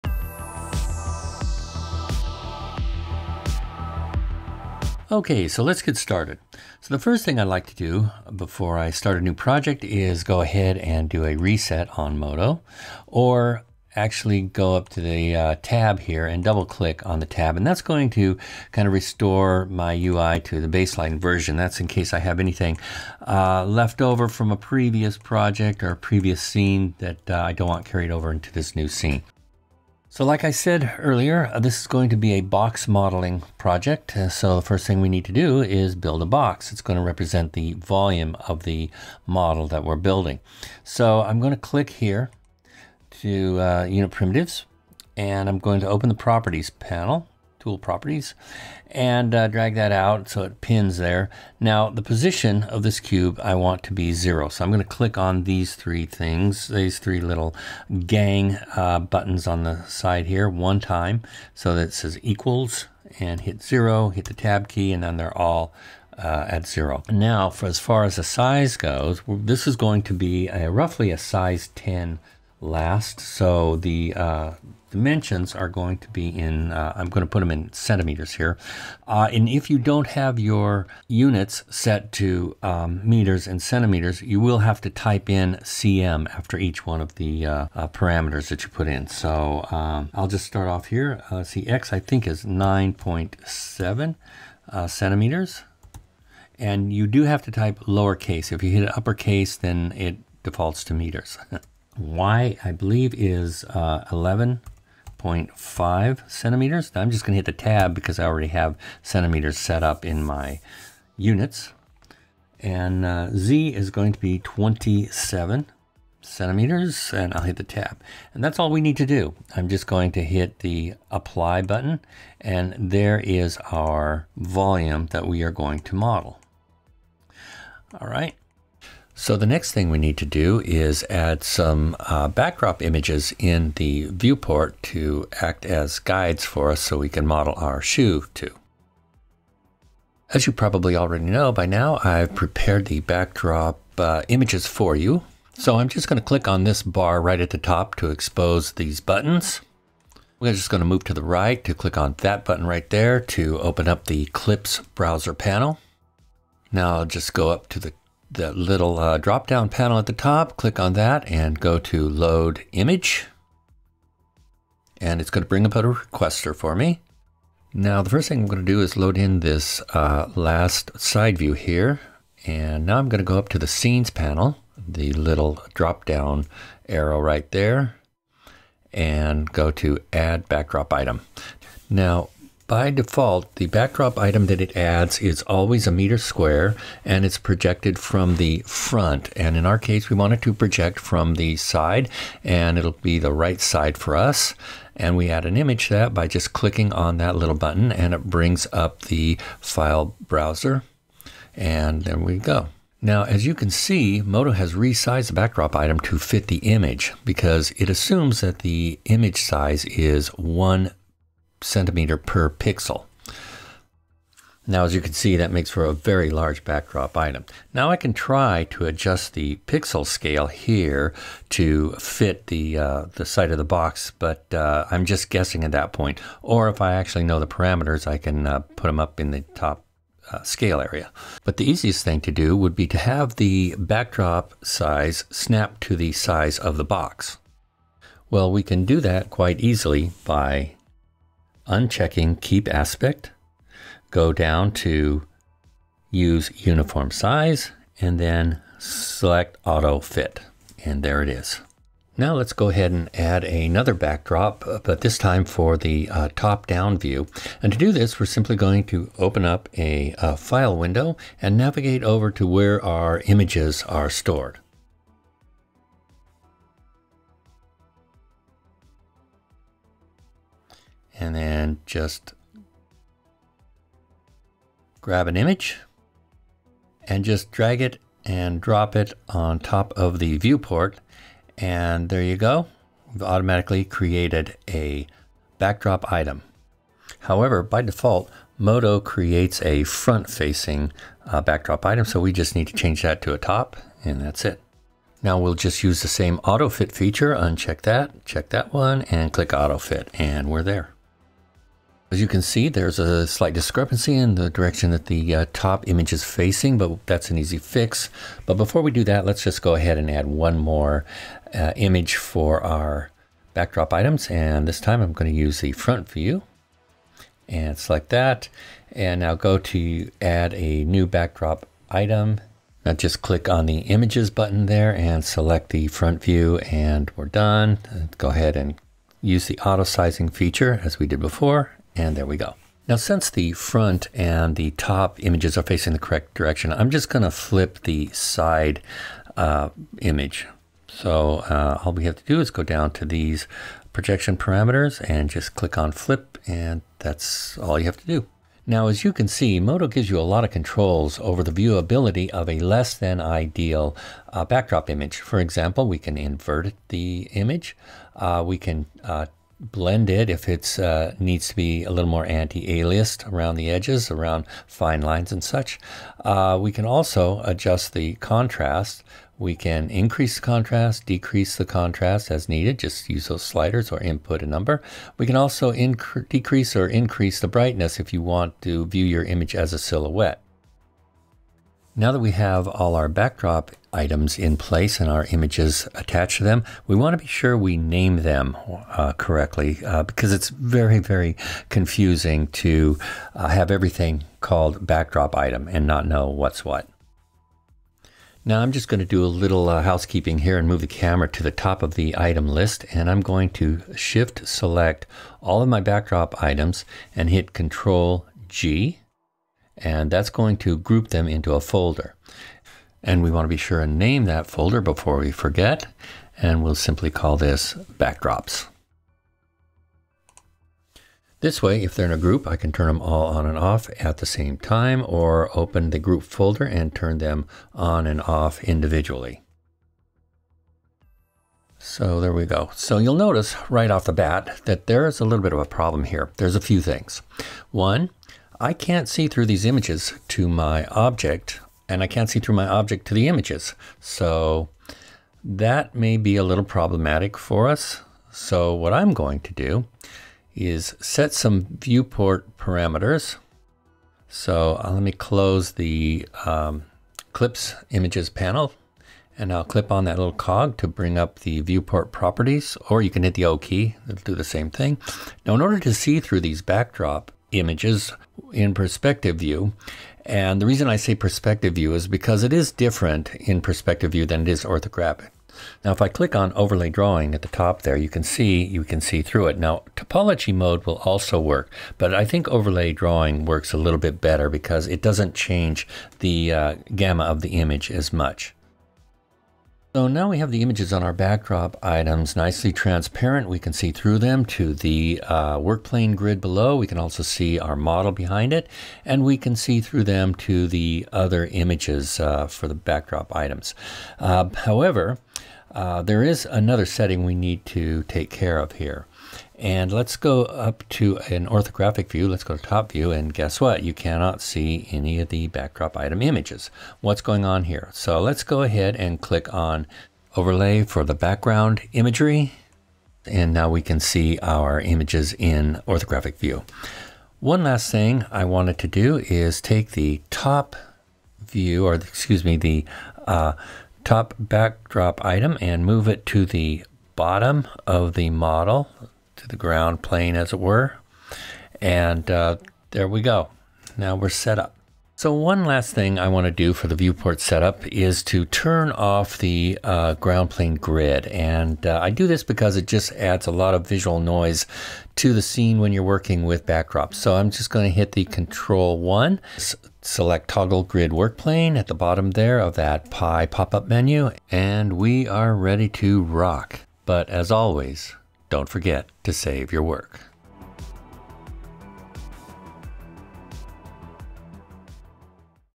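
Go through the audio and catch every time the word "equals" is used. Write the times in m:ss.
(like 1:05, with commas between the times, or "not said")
1:02.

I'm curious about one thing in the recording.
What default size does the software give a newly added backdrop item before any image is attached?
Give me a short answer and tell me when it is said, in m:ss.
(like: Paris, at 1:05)
a meter square, at 3:05.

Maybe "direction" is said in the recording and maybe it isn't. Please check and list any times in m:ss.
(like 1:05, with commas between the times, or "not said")
5:04, 5:36.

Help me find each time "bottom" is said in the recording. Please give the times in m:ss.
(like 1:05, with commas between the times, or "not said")
8:57, 9:21.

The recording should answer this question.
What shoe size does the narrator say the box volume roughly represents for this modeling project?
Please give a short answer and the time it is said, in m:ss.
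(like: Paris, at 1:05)
10, at 1:11.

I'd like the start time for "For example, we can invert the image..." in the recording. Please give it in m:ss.
5:55.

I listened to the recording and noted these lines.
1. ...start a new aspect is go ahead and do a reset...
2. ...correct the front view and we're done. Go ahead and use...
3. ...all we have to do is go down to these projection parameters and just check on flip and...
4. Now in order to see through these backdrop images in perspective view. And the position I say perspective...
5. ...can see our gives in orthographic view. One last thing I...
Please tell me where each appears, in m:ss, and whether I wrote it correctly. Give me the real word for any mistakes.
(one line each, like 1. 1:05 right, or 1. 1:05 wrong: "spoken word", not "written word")
1. 0:08 wrong: "project", not "aspect"
2. 5:25 wrong: "select", not "correct"
3. 5:41 wrong: "click", not "check"
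4. 7:45 wrong: "reason", not "position"
5. 8:43 wrong: "images", not "gives".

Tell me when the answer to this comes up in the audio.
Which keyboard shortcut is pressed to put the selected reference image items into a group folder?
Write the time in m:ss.
6:47.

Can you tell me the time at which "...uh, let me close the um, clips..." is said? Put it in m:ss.
7:34.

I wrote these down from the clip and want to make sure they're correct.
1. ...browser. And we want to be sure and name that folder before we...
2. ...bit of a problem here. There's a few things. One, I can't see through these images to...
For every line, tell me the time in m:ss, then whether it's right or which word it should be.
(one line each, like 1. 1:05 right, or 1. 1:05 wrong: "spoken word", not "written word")
1. 6:51 wrong: "folder", not "browser"
2. 7:15 right.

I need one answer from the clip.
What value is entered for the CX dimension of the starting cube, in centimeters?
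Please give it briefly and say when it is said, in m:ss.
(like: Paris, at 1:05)
9.7, at 1:32.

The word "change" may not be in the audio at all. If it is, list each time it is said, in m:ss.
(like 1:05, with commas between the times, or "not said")
4:52, 8:05.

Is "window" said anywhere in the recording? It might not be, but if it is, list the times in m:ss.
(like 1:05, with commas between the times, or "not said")
4:20.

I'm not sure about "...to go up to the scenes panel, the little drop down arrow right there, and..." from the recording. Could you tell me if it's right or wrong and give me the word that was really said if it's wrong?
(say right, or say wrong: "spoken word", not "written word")
right.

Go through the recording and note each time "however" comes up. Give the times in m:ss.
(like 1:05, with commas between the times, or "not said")
4:47, 8:24.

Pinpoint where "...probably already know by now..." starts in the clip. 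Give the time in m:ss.
2:20.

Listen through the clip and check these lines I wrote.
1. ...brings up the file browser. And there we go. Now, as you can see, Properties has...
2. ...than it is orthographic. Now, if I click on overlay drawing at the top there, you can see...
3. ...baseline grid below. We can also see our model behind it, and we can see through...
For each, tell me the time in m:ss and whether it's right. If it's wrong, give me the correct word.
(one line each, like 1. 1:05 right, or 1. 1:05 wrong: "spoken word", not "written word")
1. 3:18 wrong: "Modo", not "Properties"
2. 7:54 right
3. 8:15 wrong: "plane", not "baseline".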